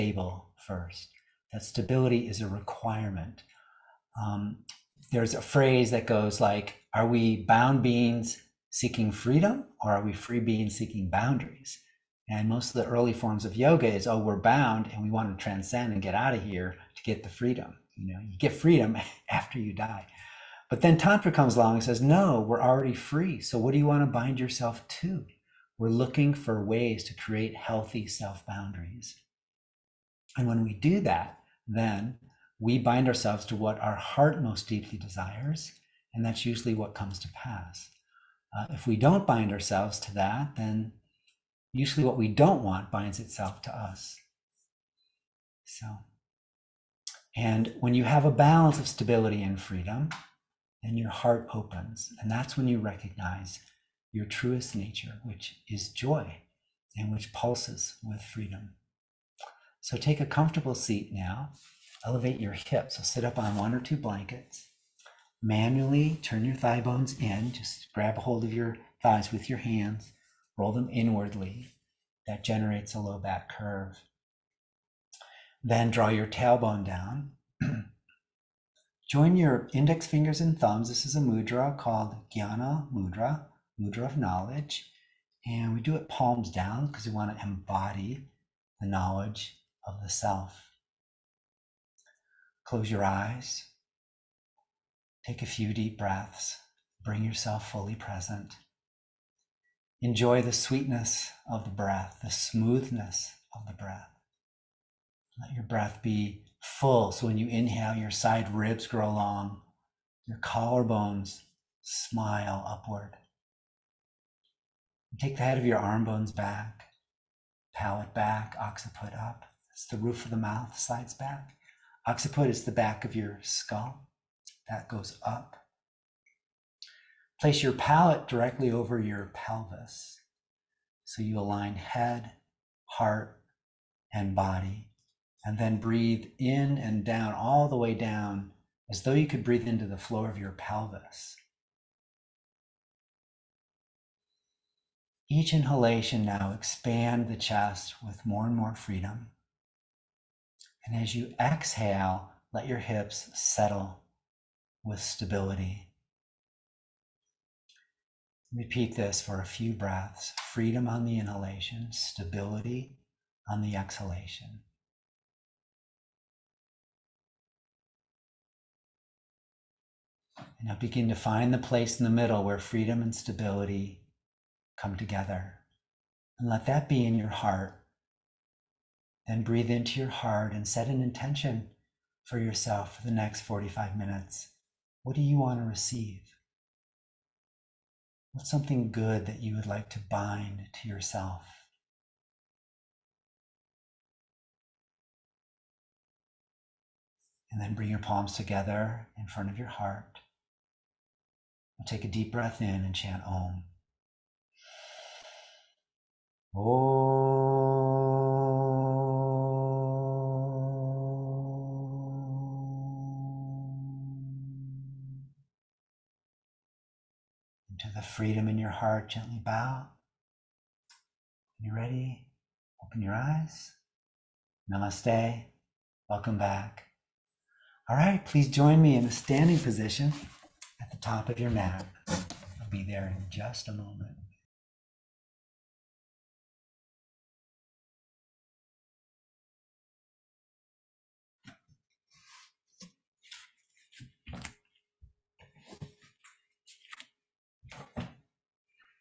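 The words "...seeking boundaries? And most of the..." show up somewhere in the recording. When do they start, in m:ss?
0:10.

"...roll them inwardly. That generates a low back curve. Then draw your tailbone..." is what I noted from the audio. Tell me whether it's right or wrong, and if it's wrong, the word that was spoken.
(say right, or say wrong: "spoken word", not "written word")
right.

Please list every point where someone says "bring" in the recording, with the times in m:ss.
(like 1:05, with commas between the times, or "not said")
1:37, 3:17.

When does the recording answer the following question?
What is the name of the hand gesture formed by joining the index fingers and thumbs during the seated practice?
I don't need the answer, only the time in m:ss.
1:22.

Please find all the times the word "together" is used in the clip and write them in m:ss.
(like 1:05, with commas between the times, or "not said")
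2:54, 3:18.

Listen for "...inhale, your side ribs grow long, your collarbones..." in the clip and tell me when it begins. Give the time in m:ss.
1:47.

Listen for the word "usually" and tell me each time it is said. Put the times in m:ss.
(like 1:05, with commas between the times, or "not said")
0:36, 0:41.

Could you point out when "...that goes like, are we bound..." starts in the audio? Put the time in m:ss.
0:05.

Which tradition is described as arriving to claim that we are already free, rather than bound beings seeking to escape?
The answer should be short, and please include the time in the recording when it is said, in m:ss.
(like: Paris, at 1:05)
Tantra, at 0:20.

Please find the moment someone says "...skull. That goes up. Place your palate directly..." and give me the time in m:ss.
2:03.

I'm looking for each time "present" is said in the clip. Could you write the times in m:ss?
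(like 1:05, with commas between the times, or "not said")
1:37.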